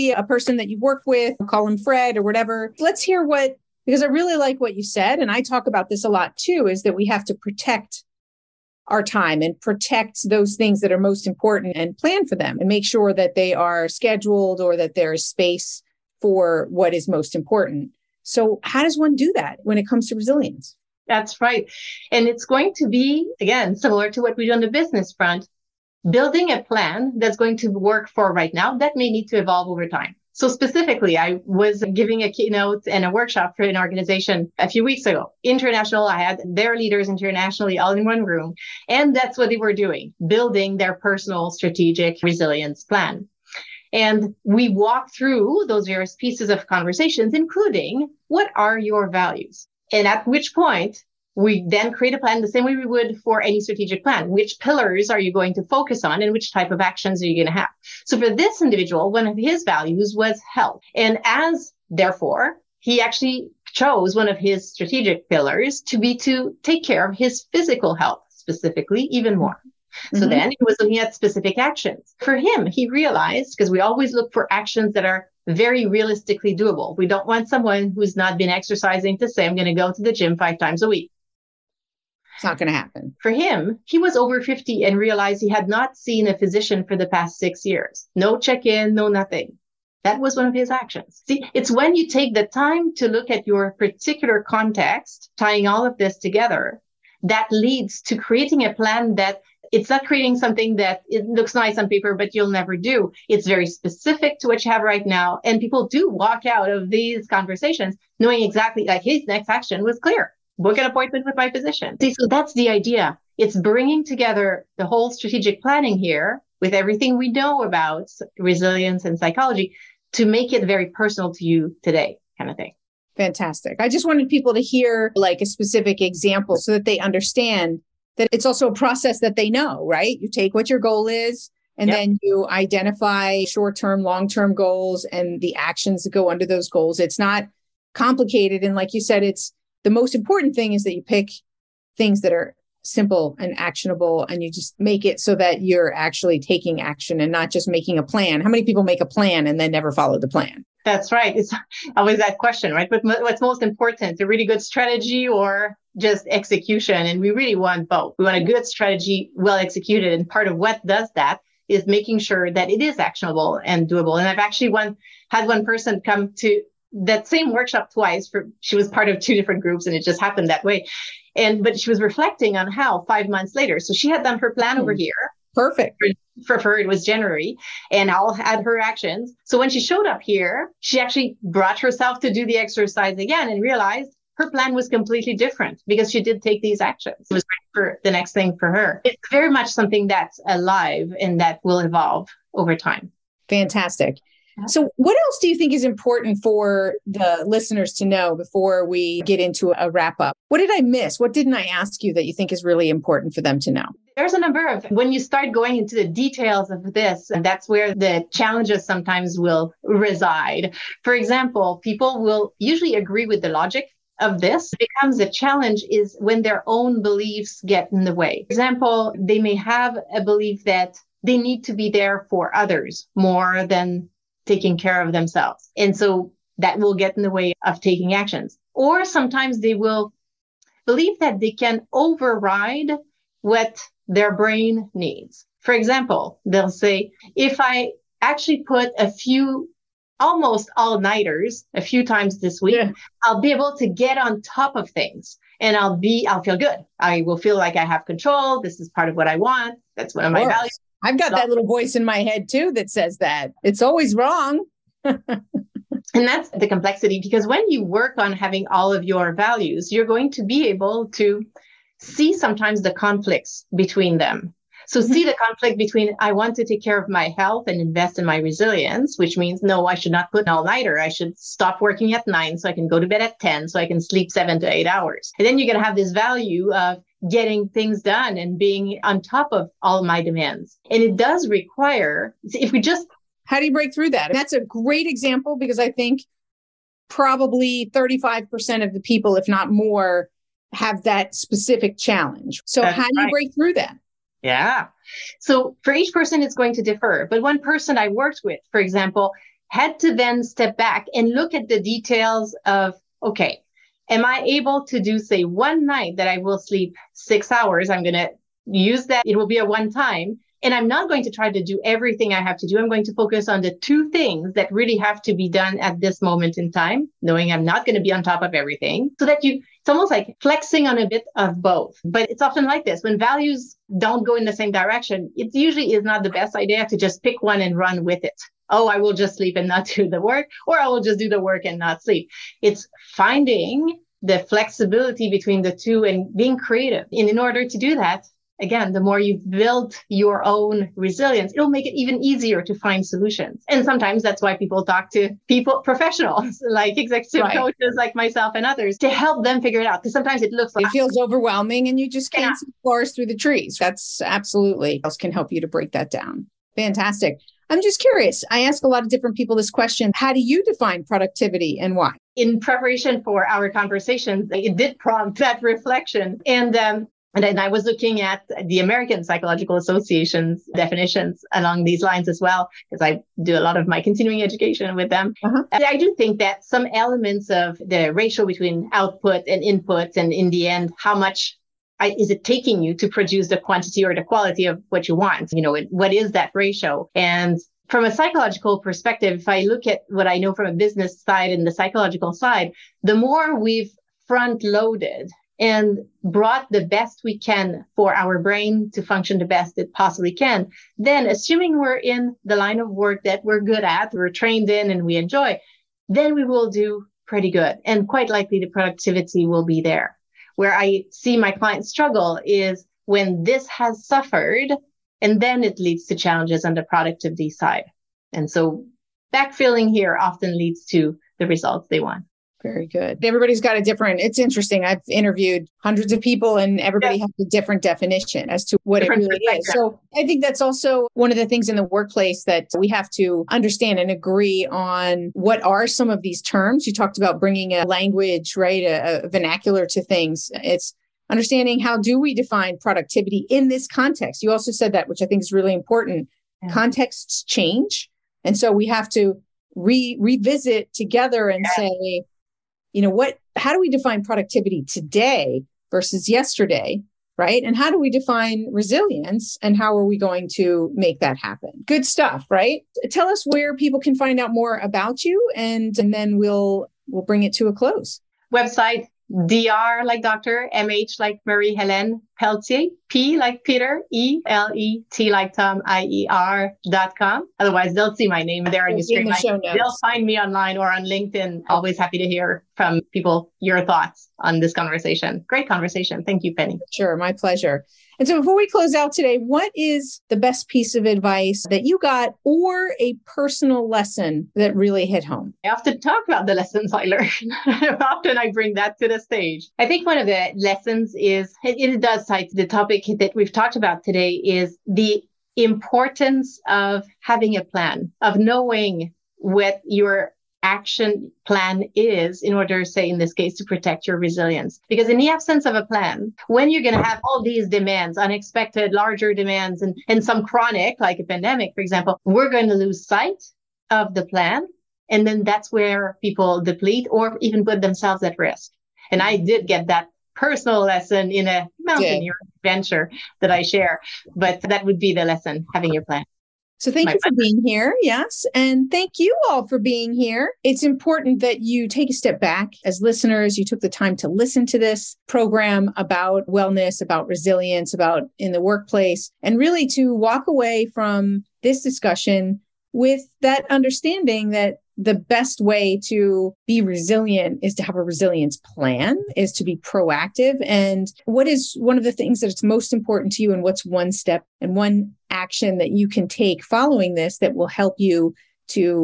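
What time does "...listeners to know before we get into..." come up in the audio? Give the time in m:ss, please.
3:17.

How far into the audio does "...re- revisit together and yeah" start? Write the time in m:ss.
7:29.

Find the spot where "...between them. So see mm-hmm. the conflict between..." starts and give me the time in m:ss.
4:23.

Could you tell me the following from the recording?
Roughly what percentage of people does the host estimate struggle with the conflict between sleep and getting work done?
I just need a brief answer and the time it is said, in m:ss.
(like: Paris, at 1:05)
35%, at 4:47.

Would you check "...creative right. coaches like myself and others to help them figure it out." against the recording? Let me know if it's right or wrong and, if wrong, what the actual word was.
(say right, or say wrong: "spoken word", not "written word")
wrong: "executive", not "creative".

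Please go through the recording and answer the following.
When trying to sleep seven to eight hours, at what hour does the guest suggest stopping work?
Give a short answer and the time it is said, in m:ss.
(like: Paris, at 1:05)
9, at 4:32.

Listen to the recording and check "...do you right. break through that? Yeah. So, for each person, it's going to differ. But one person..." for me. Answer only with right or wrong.
right.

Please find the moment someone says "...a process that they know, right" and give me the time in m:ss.
2:08.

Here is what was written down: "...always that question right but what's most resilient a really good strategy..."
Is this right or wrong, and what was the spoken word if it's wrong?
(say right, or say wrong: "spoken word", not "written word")
wrong: "important", not "resilient".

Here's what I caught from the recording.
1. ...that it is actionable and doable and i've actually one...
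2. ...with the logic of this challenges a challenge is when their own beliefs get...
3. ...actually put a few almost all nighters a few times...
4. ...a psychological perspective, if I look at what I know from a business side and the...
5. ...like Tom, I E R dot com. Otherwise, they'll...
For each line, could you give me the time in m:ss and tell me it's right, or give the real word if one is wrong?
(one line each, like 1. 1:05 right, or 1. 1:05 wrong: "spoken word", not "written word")
1. 2:42 right
2. 3:33 wrong: "becomes", not "challenges"
3. 3:58 right
4. 6:28 right
5. 7:55 right.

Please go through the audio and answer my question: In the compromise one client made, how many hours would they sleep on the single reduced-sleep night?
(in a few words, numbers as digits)
6.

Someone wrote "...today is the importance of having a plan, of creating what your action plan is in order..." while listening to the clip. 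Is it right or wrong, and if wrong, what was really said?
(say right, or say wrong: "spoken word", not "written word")
wrong: "knowing", not "creating".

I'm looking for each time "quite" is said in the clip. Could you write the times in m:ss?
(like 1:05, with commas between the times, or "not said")
6:48.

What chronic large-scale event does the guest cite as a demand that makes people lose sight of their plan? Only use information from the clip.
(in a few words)
a pandemic.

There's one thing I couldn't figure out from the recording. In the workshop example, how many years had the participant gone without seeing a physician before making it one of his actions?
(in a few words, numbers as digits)
6.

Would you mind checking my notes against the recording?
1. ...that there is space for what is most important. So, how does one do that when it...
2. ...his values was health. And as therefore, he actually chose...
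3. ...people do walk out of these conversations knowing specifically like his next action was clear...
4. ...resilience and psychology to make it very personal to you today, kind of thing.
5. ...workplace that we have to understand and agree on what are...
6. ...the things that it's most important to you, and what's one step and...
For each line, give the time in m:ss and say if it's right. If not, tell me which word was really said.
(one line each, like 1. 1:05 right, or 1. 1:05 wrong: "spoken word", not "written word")
1. 0:14 right
2. 0:59 right
3. 1:45 wrong: "exactly", not "specifically"
4. 1:58 right
5. 7:11 right
6. 9:22 right.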